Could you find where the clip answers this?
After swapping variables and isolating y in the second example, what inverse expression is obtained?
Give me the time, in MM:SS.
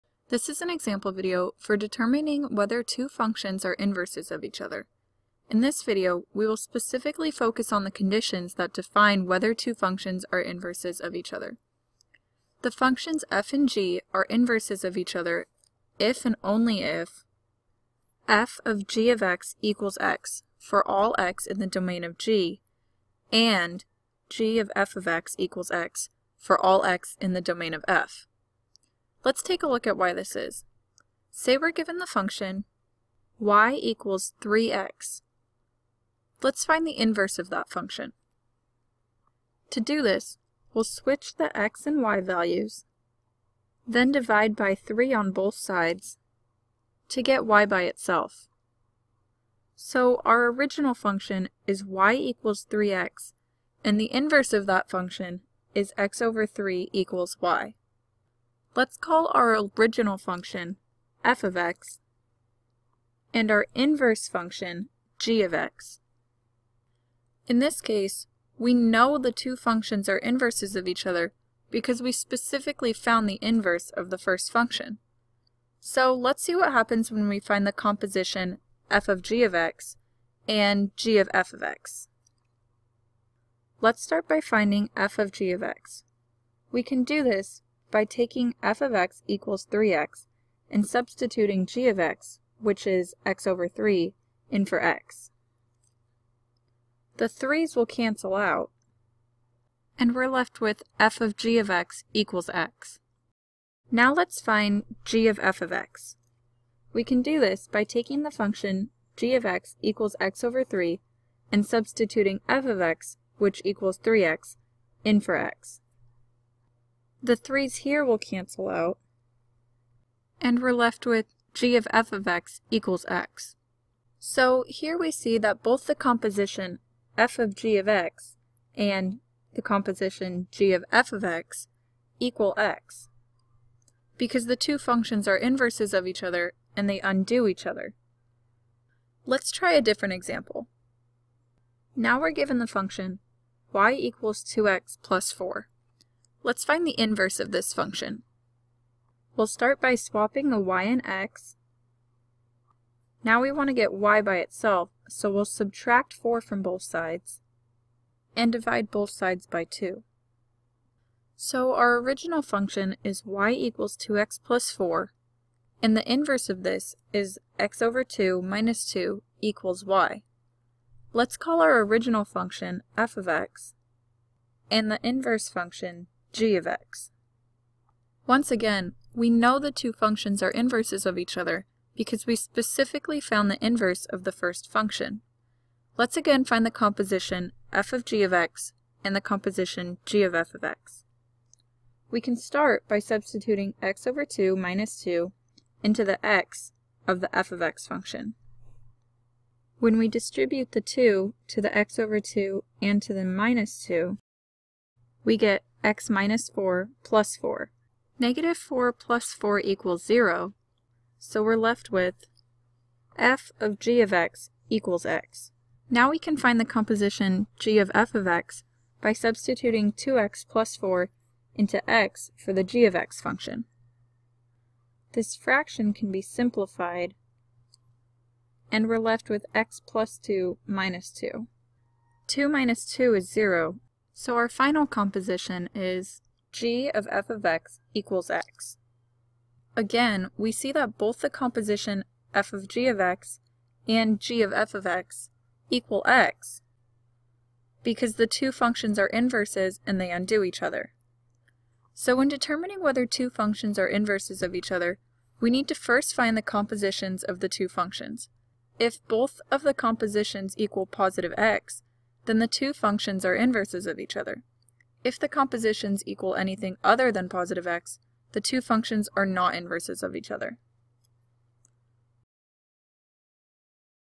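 02:47.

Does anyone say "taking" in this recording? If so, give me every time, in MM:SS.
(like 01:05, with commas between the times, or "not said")
01:28, 01:47.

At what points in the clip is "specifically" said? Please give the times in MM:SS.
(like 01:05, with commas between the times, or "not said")
00:06, 01:12, 03:02.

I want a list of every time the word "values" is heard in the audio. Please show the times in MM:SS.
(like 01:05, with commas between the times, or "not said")
00:42.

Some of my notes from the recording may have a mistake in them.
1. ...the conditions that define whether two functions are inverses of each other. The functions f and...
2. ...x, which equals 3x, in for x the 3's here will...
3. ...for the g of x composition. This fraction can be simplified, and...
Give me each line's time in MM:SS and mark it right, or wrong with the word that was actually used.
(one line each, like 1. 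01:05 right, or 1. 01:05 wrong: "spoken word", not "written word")
1. 00:07 right
2. 01:52 right
3. 03:42 wrong: "function", not "composition".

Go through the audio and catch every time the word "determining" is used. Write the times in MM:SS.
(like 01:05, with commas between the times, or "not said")
00:01, 04:12.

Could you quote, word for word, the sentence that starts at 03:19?
When we distribute the 2 to the x over 2 and to the minus 2, we get x minus 4 plus 4.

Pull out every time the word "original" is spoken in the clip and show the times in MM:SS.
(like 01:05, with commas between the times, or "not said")
00:50, 00:59, 02:41, 02:51.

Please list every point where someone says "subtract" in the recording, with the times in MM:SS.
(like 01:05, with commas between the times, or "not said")
02:35.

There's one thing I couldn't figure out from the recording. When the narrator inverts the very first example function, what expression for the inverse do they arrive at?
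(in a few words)
x/3 = y.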